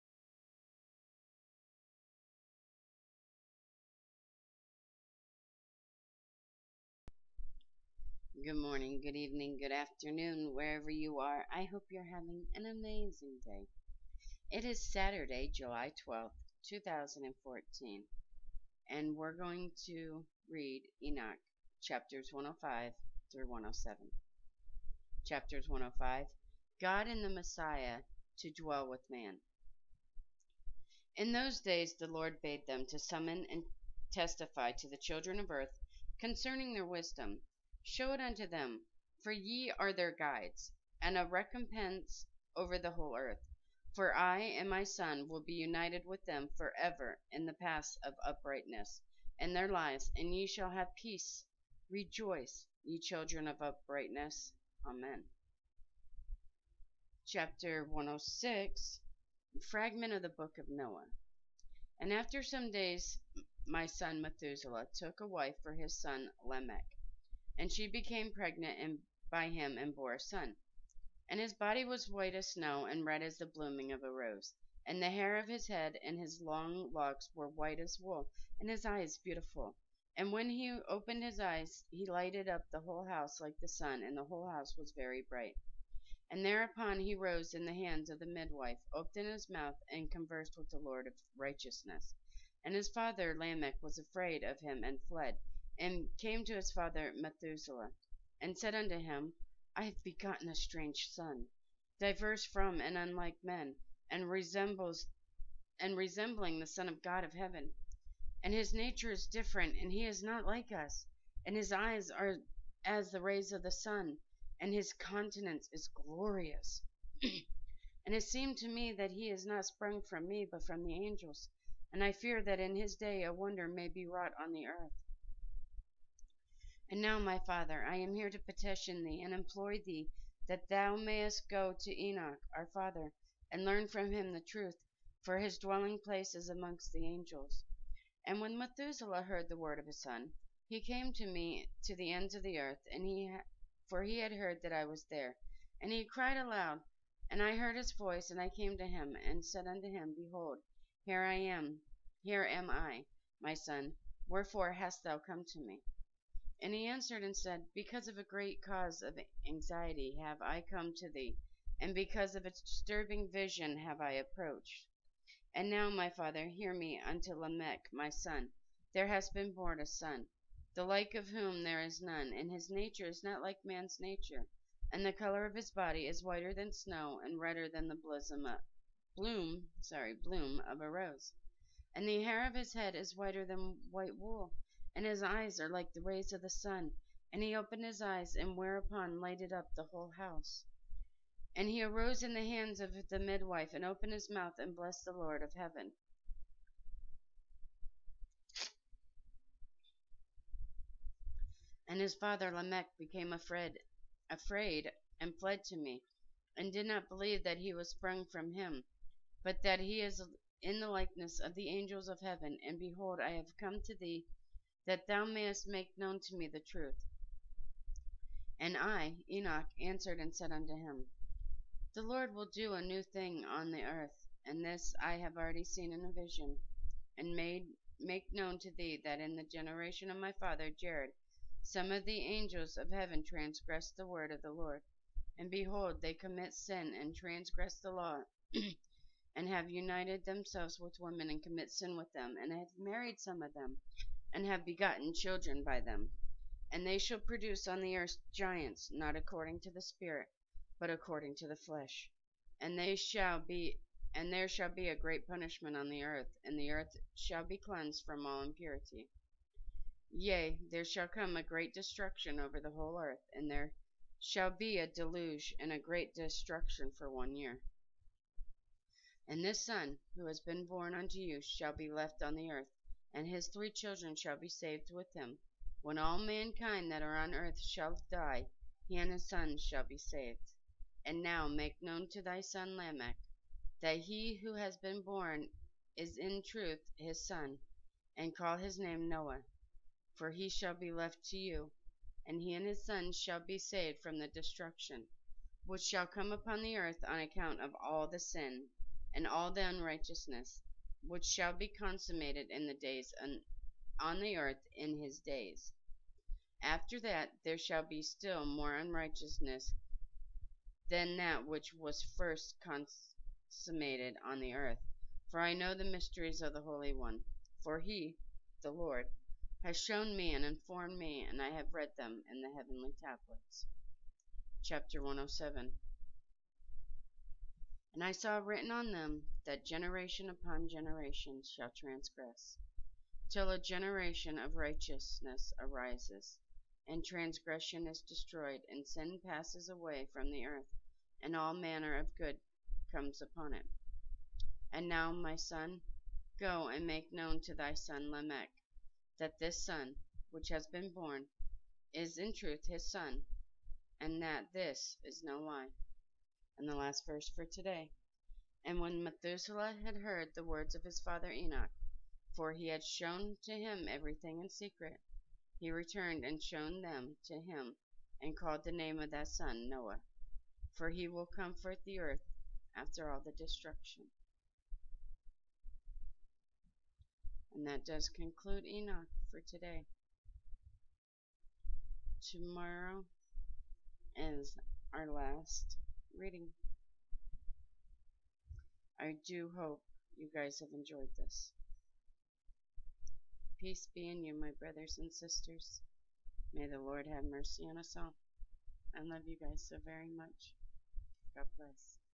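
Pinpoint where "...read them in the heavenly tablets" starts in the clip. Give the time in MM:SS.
05:21.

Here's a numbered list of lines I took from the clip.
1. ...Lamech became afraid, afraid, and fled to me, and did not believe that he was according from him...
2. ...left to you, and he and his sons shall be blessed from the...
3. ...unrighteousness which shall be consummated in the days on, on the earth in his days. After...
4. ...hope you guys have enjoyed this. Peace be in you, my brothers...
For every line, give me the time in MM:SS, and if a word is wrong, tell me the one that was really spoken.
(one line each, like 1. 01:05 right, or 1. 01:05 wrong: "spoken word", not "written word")
1. 03:22 wrong: "sprung", not "according"
2. 04:50 wrong: "saved", not "blessed"
3. 04:59 right
4. 06:29 right.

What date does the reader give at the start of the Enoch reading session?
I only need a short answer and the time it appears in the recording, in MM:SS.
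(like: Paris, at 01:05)
Saturday, July 12th, 2014, at 00:14.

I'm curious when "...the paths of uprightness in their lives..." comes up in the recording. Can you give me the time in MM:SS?
00:47.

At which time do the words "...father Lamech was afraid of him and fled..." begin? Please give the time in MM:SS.
01:32.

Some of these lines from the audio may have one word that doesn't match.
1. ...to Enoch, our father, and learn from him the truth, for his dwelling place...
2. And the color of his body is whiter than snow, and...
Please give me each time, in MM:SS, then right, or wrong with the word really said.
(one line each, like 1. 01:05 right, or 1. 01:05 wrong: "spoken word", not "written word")
1. 02:11 right
2. 02:54 right.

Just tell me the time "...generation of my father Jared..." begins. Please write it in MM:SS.
03:49.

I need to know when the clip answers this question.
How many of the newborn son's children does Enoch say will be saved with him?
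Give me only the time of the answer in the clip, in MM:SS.
04:33.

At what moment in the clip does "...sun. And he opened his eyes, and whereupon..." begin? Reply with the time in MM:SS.
03:06.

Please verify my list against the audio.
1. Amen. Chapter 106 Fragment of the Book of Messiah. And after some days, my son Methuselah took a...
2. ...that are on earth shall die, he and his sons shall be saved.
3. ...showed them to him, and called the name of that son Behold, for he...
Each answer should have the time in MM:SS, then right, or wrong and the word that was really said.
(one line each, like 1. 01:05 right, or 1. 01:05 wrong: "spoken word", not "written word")
1. 00:54 wrong: "Noah", not "Messiah"
2. 04:36 right
3. 06:06 wrong: "Noah", not "Behold".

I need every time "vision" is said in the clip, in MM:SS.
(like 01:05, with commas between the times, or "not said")
02:43, 03:46.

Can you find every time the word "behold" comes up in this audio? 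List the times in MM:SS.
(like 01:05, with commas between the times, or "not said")
02:30, 03:32, 03:55.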